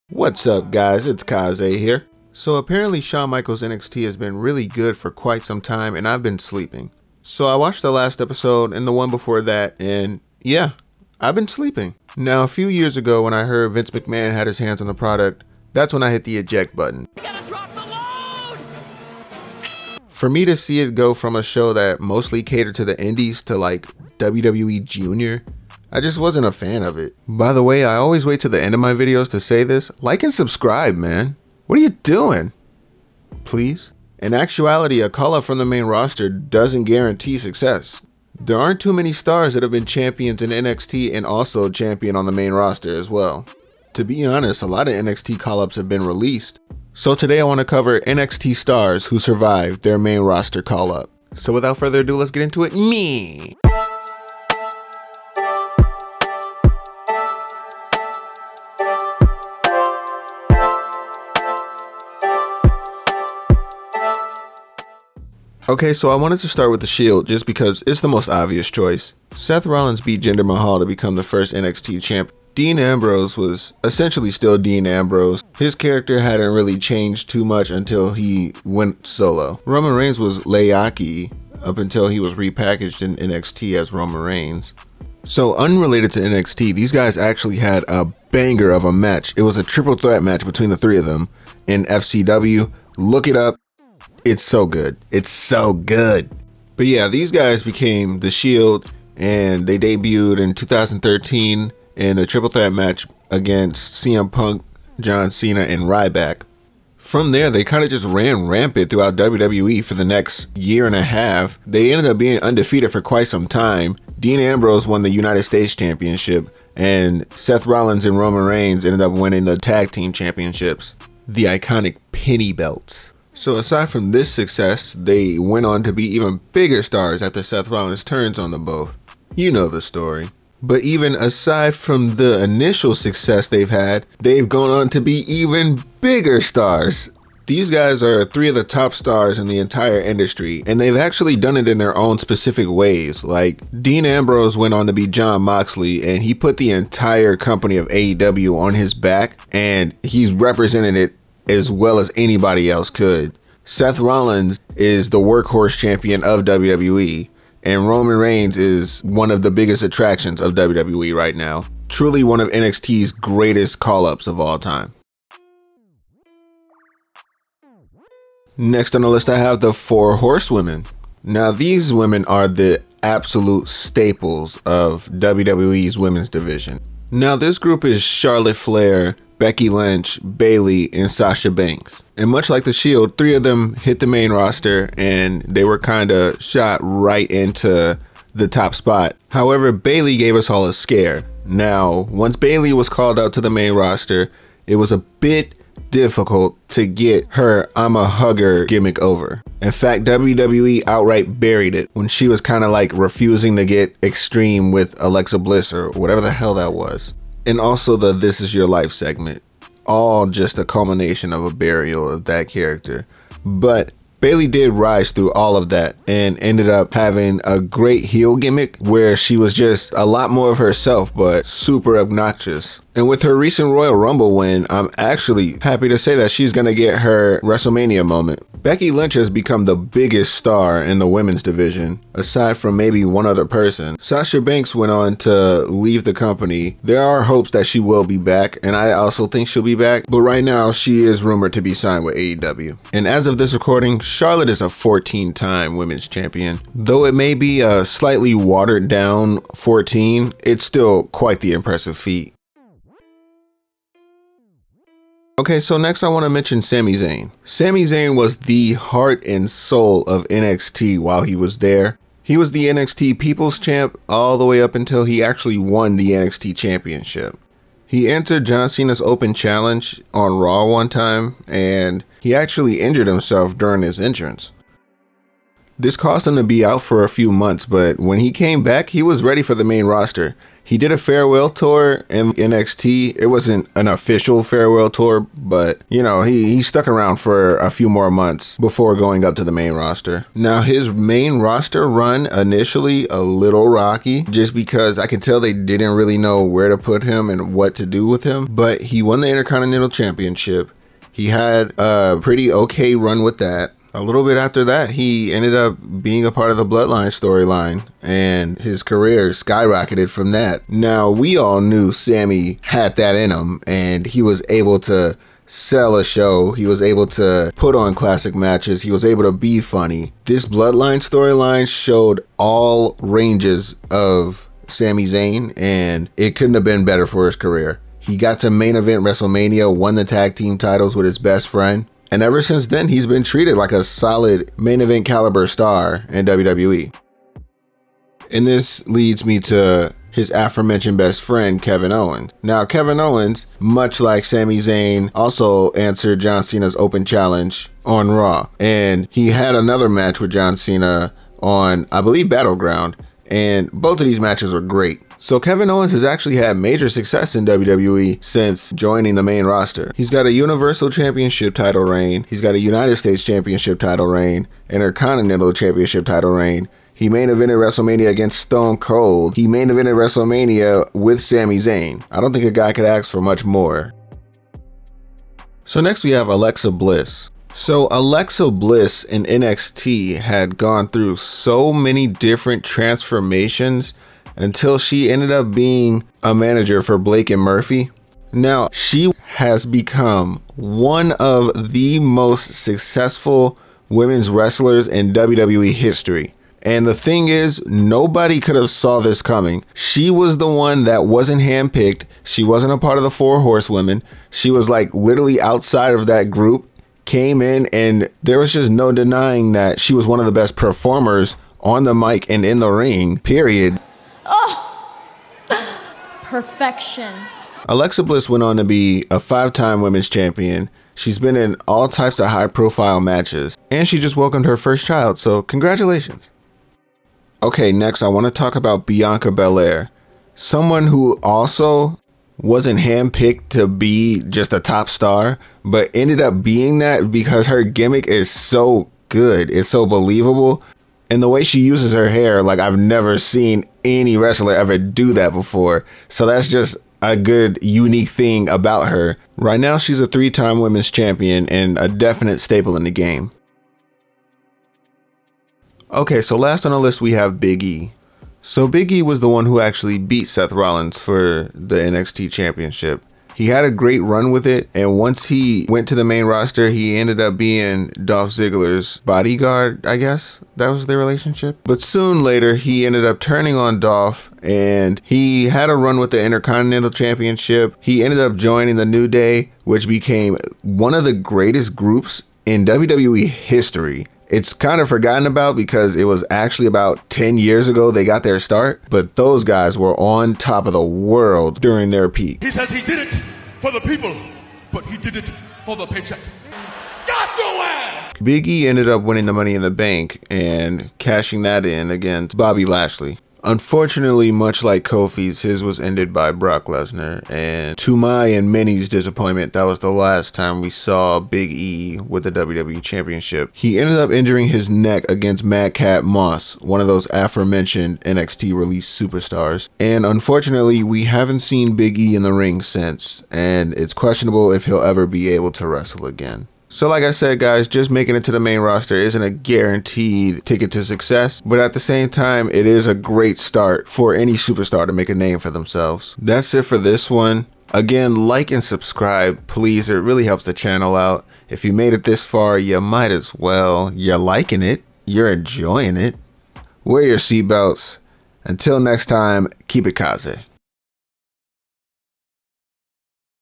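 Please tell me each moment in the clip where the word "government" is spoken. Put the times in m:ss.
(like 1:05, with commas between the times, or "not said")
not said.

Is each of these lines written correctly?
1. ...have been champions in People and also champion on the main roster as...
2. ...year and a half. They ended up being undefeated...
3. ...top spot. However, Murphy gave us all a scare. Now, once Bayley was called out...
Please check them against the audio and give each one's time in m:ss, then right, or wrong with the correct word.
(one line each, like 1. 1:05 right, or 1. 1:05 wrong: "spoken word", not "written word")
1. 0:39 wrong: "NXT", not "People"
2. 1:50 right
3. 3:08 wrong: "Bayley", not "Murphy".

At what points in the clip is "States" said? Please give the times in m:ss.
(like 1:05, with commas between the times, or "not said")
1:55, 6:02.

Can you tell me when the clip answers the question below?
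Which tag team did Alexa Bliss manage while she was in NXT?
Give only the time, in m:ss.
6:26.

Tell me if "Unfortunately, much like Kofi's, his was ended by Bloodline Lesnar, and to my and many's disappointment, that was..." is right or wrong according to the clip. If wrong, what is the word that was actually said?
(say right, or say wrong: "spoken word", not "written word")
wrong: "Brock", not "Bloodline".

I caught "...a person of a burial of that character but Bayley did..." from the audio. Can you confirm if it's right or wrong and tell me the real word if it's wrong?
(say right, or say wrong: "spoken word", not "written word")
wrong: "culmination", not "person".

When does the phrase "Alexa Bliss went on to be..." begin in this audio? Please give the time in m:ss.
6:57.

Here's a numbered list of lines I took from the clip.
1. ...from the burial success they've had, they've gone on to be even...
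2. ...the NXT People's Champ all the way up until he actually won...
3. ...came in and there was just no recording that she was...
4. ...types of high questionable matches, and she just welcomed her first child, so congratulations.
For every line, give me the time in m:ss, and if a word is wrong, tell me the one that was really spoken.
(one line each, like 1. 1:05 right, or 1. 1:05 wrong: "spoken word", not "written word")
1. 2:11 wrong: "initial", not "burial"
2. 4:22 right
3. 6:47 wrong: "denying", not "recording"
4. 7:01 wrong: "profile", not "questionable".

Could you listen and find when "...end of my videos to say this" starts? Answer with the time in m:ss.
0:28.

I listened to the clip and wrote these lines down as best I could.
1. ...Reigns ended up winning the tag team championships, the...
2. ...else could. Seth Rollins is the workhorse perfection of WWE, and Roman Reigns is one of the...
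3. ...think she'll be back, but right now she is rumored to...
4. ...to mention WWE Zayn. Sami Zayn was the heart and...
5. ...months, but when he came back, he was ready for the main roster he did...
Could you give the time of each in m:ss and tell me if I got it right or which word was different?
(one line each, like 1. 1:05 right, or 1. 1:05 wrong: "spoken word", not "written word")
1. 1:58 right
2. 2:32 wrong: "champion", not "perfection"
3. 3:59 right
4. 4:16 wrong: "Sami", not "WWE"
5. 4:37 right.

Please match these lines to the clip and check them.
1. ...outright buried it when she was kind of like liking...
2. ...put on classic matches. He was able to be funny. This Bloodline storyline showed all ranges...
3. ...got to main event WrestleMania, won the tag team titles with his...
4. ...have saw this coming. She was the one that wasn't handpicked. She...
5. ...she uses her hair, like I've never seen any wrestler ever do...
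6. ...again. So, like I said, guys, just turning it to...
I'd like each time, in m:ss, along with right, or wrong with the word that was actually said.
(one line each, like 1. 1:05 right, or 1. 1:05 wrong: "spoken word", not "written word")
1. 3:20 wrong: "refusing", not "liking"
2. 5:17 right
3. 5:28 right
4. 6:38 right
5. 7:21 right
6. 8:46 wrong: "making", not "turning".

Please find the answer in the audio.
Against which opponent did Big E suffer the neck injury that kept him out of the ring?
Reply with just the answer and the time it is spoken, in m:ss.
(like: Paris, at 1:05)
Madcap Moss, at 8:35.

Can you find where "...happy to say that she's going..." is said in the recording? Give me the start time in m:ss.
3:45.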